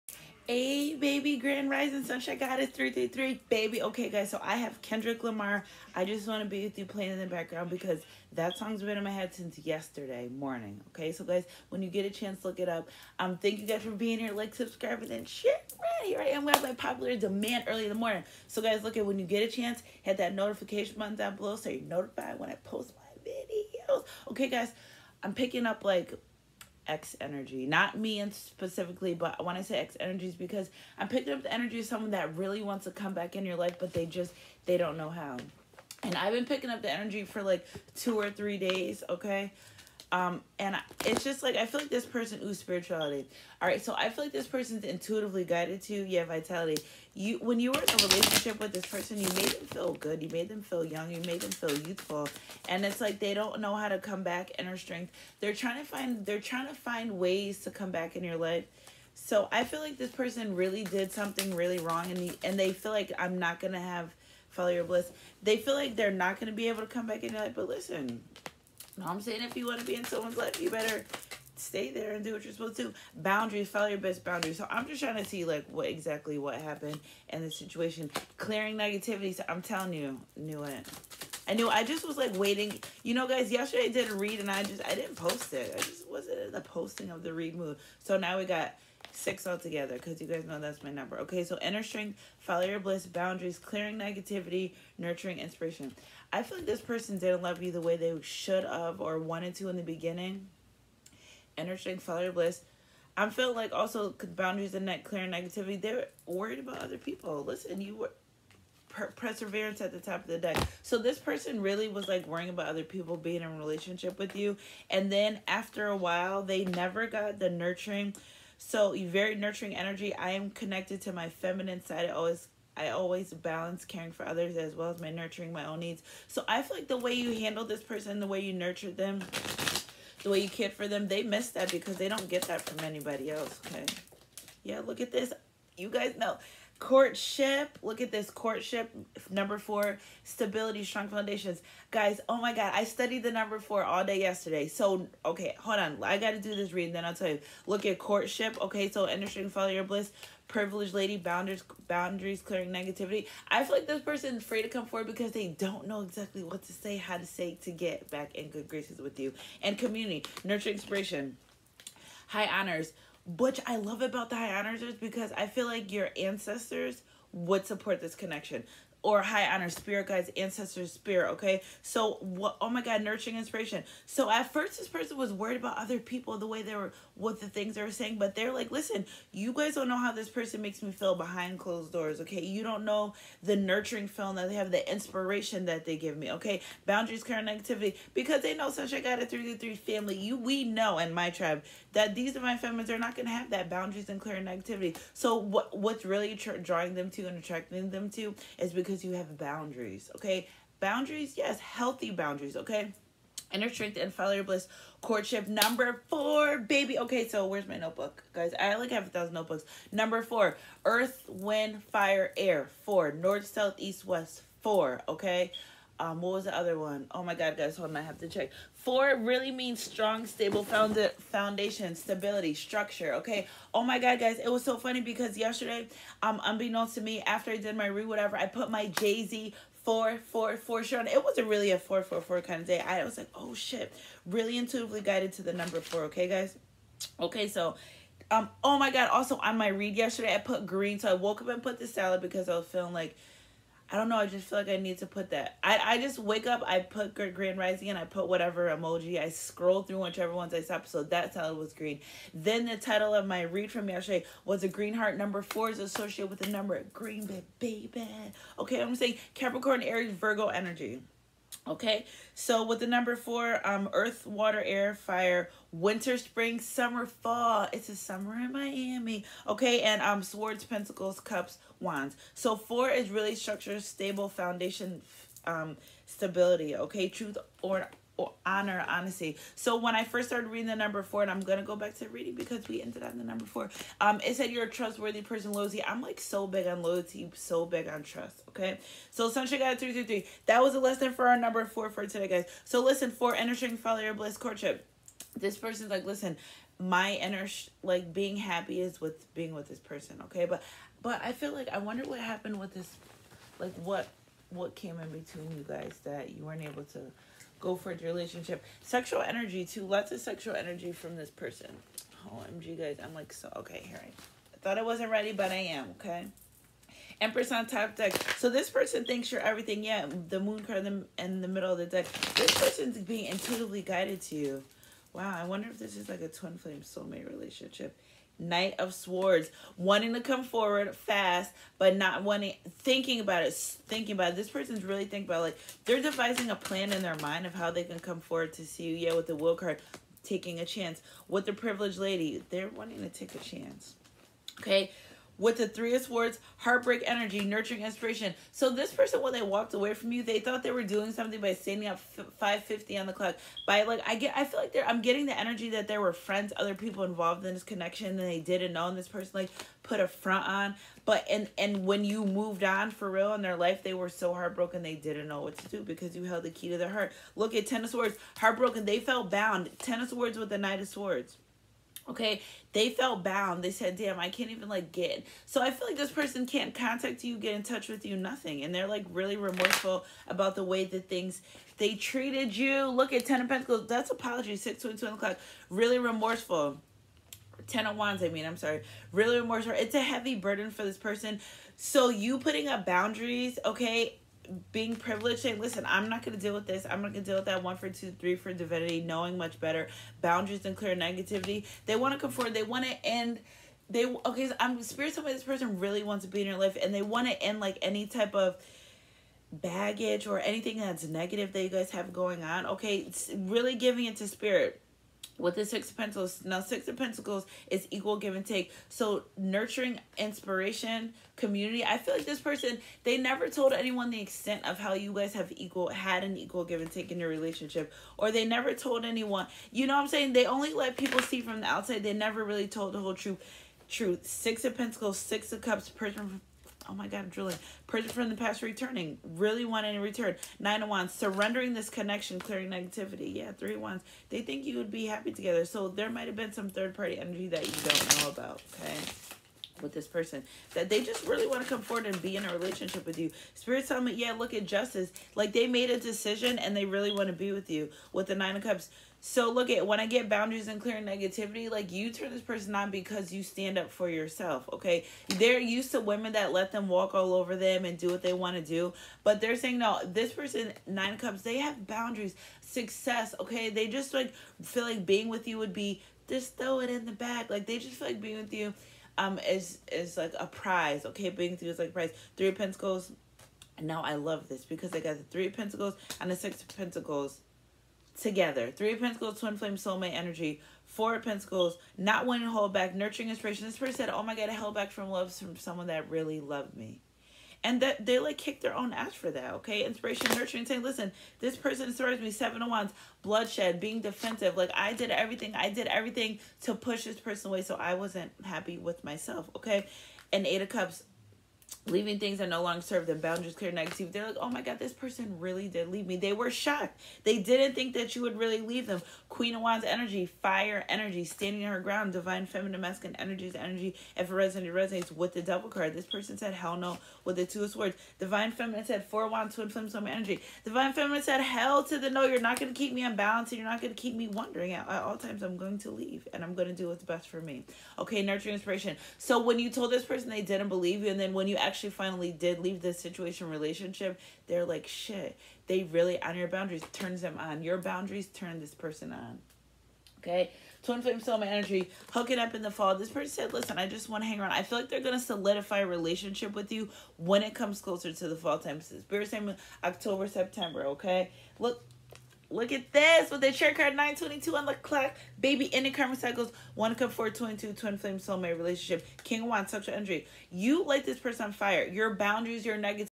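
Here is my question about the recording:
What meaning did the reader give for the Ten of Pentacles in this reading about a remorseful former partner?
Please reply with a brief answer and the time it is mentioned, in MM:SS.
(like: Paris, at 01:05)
apology, at 06:24.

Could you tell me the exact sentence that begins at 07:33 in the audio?
Spirit tell me, yeah, look at justice.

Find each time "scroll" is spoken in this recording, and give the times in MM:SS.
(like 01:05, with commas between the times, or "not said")
04:09.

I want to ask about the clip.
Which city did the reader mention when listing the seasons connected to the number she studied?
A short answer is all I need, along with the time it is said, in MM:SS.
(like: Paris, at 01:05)
Miami, at 04:28.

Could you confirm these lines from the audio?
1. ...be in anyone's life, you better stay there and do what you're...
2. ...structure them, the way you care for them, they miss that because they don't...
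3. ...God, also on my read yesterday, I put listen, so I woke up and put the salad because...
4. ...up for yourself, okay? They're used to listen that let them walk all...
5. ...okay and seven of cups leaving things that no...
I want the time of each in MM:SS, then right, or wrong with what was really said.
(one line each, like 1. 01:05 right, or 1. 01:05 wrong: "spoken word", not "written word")
1. 01:09 wrong: "someone", not "anyone"
2. 02:08 wrong: "nurture", not "structure"
3. 03:58 wrong: "green", not "listen"
4. 07:43 wrong: "women", not "listen"
5. 08:29 wrong: "eight", not "seven".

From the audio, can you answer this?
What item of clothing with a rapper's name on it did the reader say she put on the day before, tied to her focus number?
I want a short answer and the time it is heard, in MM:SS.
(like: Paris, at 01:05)
Jay Z 444 shirt, at 03:48.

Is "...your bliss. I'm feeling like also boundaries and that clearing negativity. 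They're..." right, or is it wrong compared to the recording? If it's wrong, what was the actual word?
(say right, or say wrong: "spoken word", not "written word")
right.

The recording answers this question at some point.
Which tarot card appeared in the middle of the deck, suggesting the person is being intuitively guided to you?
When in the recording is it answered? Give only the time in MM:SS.
05:20.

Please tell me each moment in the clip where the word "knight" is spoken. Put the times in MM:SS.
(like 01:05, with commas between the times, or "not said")
05:28, 06:10.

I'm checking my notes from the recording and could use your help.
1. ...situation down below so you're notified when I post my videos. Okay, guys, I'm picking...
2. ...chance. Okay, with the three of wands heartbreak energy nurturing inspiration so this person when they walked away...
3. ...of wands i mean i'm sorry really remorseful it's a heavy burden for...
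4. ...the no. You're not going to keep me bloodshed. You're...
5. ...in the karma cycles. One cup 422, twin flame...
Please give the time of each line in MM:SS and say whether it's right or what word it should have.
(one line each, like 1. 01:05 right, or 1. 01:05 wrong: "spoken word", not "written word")
1. 00:20 wrong: "button", not "situation"
2. 05:43 wrong: "swords", not "wands"
3. 06:27 right
4. 08:51 wrong: "unbalanced", not "bloodshed"
5. 09:25 right.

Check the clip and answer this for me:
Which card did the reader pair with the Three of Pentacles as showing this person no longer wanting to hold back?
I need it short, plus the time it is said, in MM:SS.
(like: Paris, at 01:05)
Four of Pentacles, at 08:10.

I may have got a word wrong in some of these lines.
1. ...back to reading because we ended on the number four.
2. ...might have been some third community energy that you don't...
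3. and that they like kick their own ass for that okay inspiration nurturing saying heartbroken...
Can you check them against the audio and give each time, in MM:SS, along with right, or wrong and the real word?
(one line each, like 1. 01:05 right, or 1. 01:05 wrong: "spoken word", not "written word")
1. 04:41 right
2. 07:26 wrong: "party", not "community"
3. 08:17 wrong: "listen", not "heartbroken".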